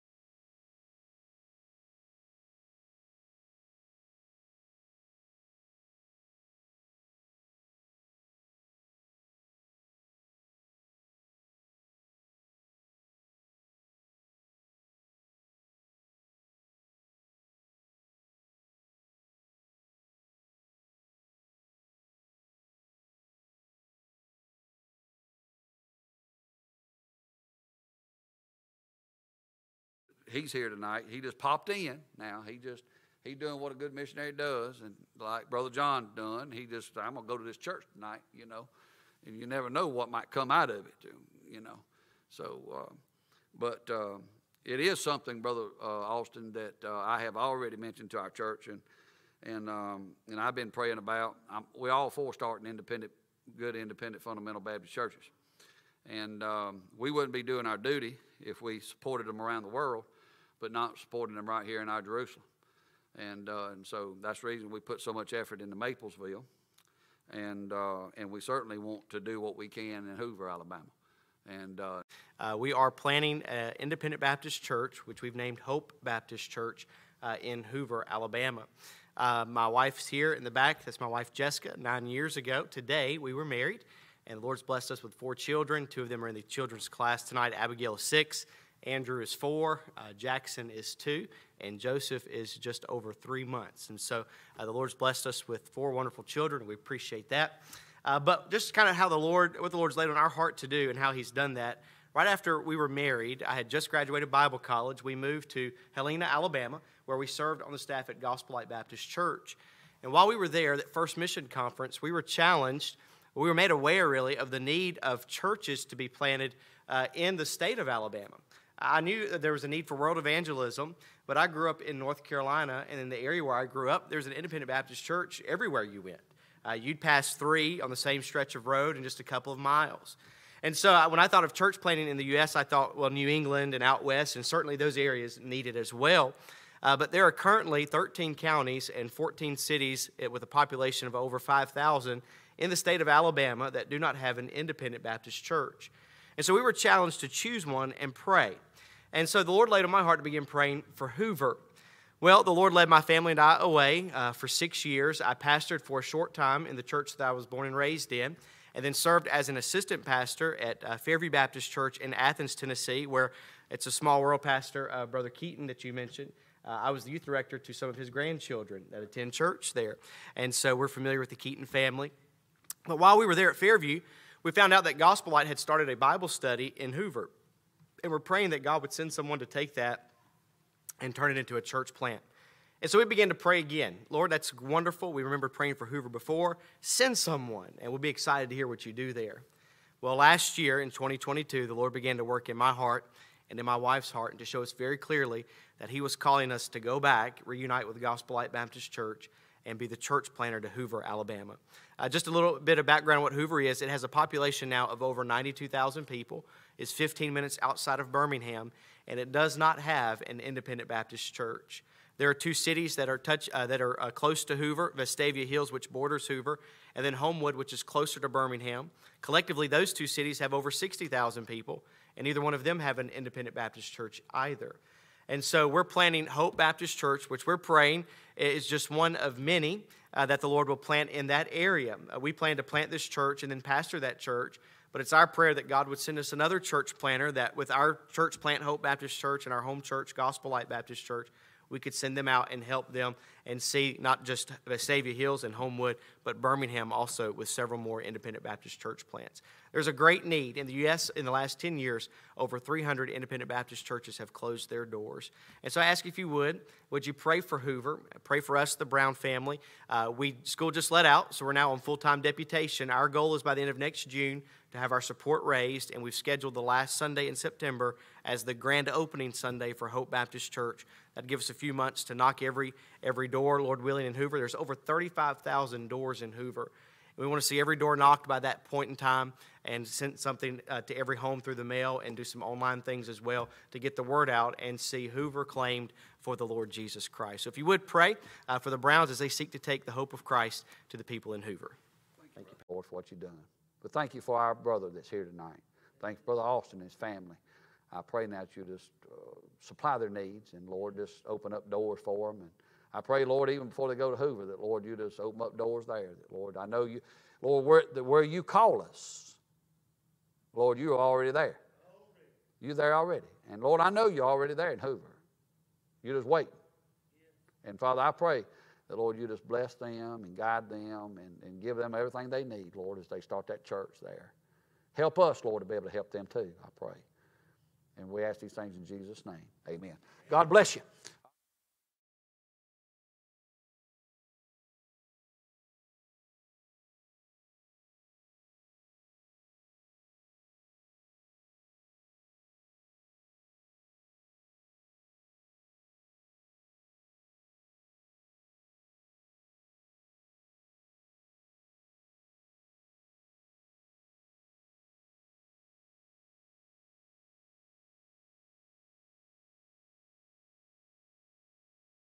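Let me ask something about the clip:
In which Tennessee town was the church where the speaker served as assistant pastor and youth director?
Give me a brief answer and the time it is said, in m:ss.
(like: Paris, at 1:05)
Athens, at 2:42.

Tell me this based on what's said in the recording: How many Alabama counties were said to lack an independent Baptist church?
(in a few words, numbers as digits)
13.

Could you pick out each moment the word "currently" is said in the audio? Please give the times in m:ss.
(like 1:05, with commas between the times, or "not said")
2:17.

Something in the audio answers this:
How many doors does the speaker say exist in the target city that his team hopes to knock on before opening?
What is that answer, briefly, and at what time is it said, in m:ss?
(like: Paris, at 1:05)
Over 35,000, at 4:34.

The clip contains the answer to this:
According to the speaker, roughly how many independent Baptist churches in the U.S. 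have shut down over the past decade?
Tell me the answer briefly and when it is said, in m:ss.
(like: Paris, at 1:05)
Over 300, at 4:12.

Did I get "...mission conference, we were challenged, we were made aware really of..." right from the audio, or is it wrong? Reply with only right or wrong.
right.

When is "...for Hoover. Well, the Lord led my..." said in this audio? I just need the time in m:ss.
2:30.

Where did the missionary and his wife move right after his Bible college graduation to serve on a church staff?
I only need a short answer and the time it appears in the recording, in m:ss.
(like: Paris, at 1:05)
Helena, Alabama, at 1:45.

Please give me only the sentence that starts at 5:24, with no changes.
Help us, Lord, to be able to help them too, I pray.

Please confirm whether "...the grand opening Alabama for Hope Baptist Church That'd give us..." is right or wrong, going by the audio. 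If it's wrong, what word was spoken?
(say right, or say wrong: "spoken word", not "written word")
wrong: "Sunday", not "Alabama".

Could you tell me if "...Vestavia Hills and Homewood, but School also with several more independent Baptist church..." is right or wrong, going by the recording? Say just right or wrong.
wrong.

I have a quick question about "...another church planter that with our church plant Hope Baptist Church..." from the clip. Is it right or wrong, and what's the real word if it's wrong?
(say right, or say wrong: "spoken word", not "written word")
right.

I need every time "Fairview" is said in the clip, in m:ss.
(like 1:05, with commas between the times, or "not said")
2:40, 2:53.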